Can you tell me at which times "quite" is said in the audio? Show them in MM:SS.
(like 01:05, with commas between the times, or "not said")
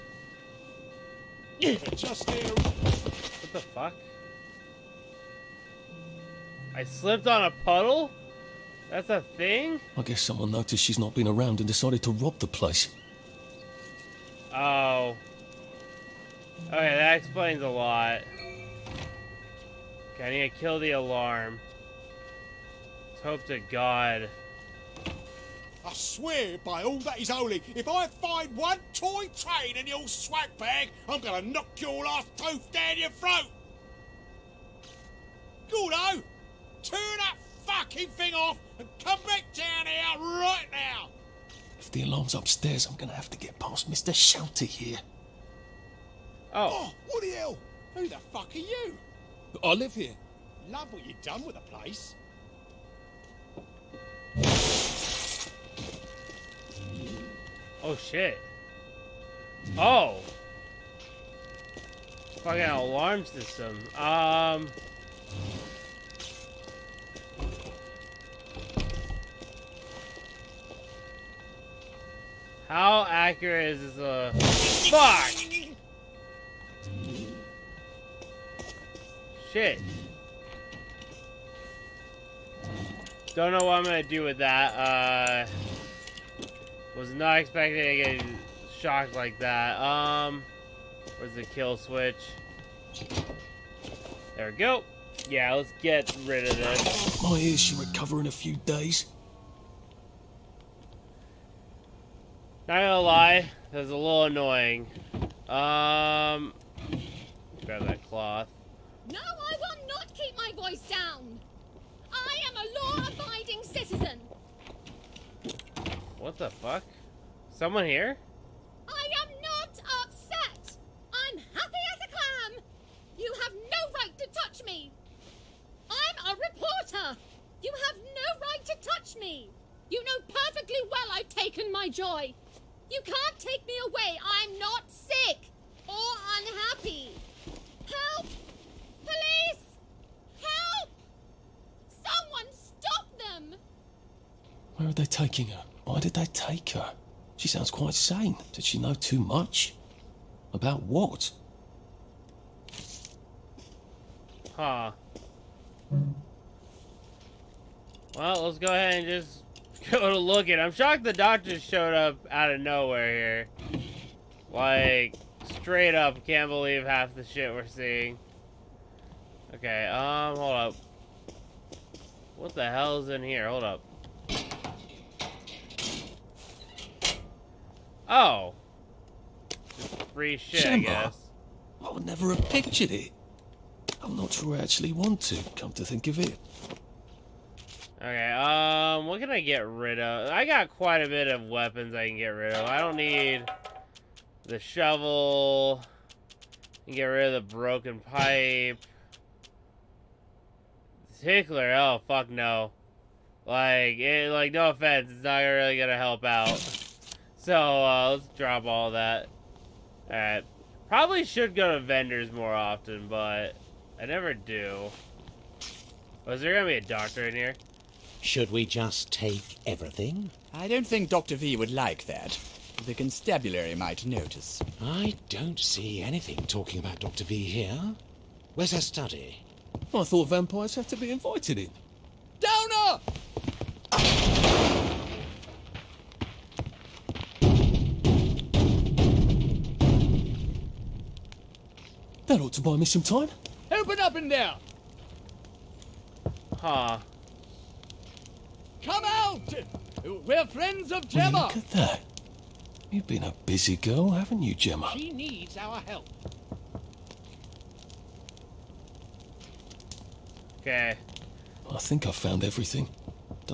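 02:27, 03:10.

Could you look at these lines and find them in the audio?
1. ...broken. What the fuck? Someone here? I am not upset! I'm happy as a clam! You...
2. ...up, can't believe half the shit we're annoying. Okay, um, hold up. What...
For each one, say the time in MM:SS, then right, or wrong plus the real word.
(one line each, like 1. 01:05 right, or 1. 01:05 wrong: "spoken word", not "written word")
1. 01:53 wrong: "citizen", not "broken"
2. 02:45 wrong: "seeing", not "annoying".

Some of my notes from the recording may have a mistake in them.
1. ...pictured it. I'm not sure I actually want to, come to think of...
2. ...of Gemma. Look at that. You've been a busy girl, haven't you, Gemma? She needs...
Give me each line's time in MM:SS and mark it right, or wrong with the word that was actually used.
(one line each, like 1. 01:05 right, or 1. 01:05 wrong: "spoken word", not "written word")
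1. 03:02 right
2. 04:10 right.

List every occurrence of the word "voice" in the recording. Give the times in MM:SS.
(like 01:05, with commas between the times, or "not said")
01:50.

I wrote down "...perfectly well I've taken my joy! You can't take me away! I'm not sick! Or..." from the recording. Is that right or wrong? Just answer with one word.
right.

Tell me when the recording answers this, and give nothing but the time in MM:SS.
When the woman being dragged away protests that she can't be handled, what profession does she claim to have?
02:06.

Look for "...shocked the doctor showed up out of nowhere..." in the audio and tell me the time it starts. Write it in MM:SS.
02:40.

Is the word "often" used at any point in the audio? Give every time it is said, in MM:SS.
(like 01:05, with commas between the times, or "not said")
03:32.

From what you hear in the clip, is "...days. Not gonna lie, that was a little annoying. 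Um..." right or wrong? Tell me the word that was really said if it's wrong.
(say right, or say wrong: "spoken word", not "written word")
right.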